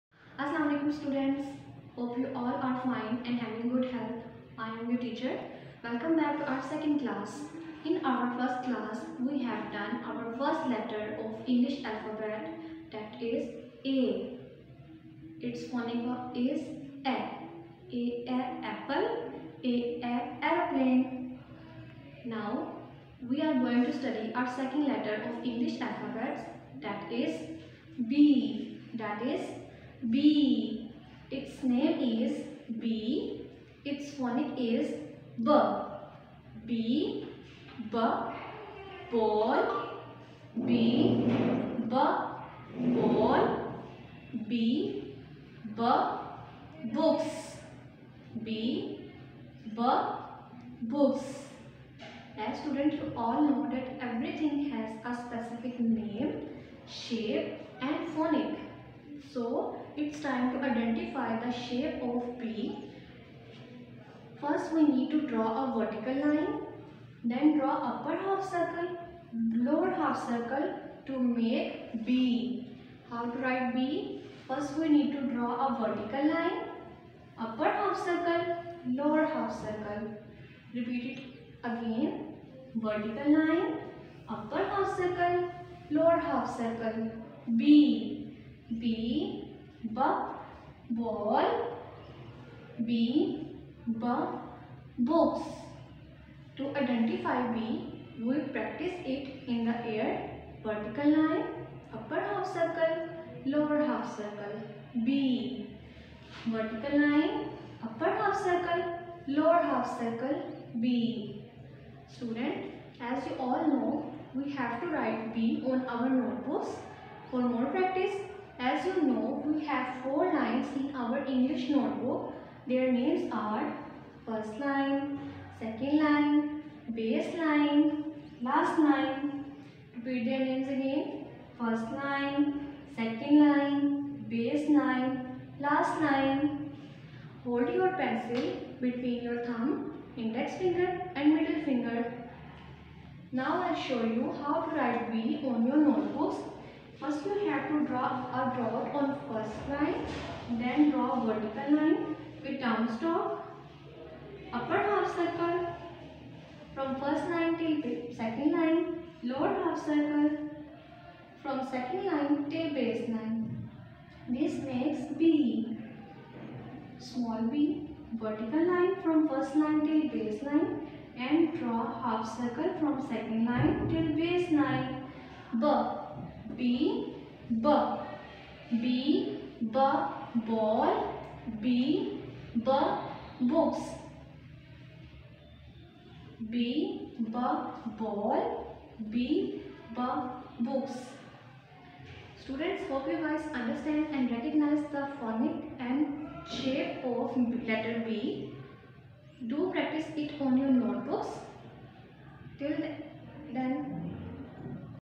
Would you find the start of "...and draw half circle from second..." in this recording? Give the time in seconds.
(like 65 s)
171 s.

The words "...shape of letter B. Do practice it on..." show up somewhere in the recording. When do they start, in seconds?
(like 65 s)
196 s.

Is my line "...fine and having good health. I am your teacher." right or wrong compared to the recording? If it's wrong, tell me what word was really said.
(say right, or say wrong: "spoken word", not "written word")
right.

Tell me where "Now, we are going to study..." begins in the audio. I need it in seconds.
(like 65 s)
22 s.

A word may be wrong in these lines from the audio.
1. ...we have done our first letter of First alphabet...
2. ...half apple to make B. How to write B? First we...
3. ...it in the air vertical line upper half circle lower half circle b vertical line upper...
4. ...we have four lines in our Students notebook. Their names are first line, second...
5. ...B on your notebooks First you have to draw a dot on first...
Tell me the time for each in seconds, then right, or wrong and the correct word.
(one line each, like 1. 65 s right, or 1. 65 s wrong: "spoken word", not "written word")
1. 9 s wrong: "English", not "First"
2. 69 s wrong: "circle", not "apple"
3. 99 s right
4. 119 s wrong: "English", not "Students"
5. 145 s right.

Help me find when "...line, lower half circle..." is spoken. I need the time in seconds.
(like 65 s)
158 s.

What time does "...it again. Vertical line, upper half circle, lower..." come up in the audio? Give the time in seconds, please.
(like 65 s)
81 s.